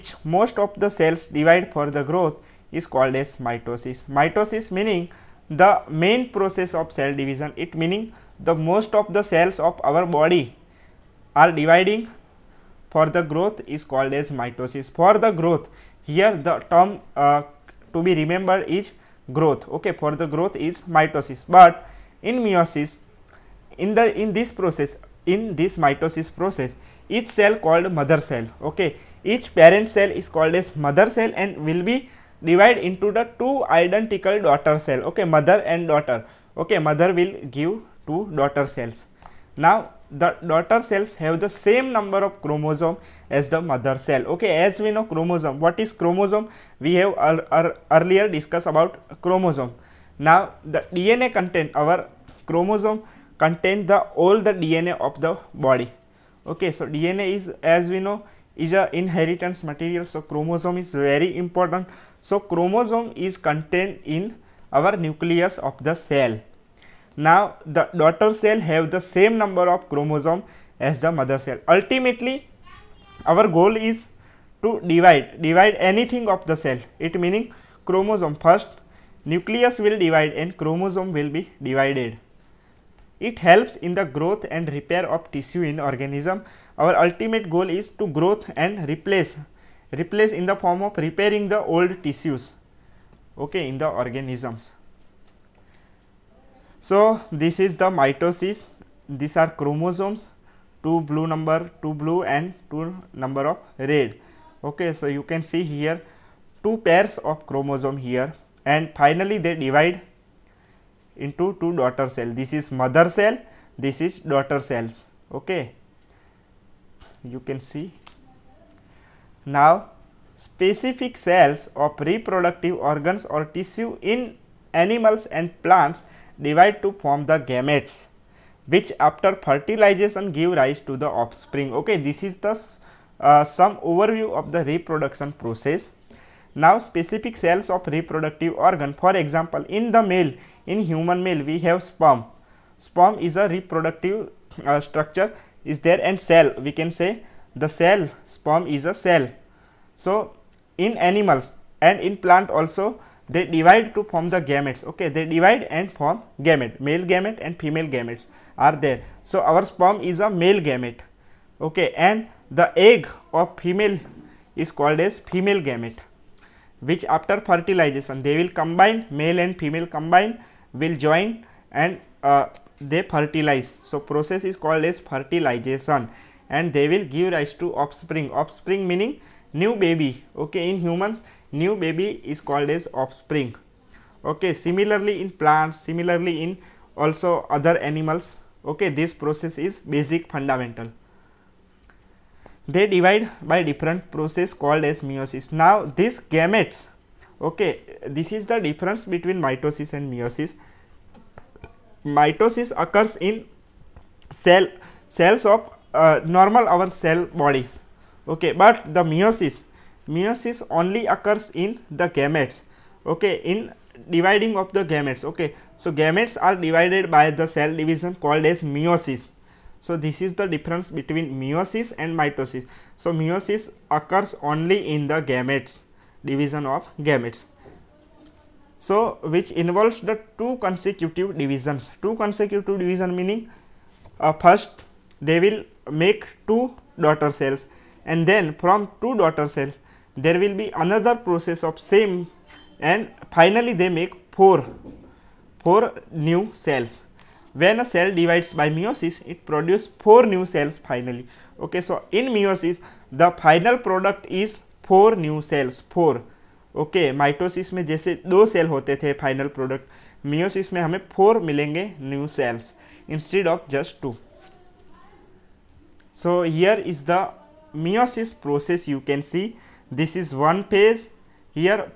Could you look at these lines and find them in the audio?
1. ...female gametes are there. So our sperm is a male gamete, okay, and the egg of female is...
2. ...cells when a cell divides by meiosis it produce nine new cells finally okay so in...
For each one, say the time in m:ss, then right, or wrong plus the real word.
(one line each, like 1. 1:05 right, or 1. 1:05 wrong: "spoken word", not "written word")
1. 2:37 right
2. 4:06 wrong: "four", not "nine".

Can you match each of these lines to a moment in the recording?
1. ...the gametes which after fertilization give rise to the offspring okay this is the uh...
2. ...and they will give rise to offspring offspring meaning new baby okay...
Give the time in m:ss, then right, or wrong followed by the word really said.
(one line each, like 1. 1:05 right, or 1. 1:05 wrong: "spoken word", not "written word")
1. 2:07 right
2. 2:56 right.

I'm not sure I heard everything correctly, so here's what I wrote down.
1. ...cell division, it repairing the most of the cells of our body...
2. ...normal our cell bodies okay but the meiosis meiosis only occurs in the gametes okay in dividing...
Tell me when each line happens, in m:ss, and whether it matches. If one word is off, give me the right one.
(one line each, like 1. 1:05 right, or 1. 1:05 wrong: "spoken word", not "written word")
1. 0:06 wrong: "meaning", not "repairing"
2. 3:26 right.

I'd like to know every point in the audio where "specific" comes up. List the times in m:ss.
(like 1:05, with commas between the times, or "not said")
2:00, 2:16.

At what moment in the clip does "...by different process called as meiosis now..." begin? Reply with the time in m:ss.
3:13.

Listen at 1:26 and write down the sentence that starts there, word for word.
Our ultimate goal is to growth and replace, replace in the form of repairing the old tissues, okay, in the organisms.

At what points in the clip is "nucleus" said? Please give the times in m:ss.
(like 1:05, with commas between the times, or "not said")
1:05, 1:19.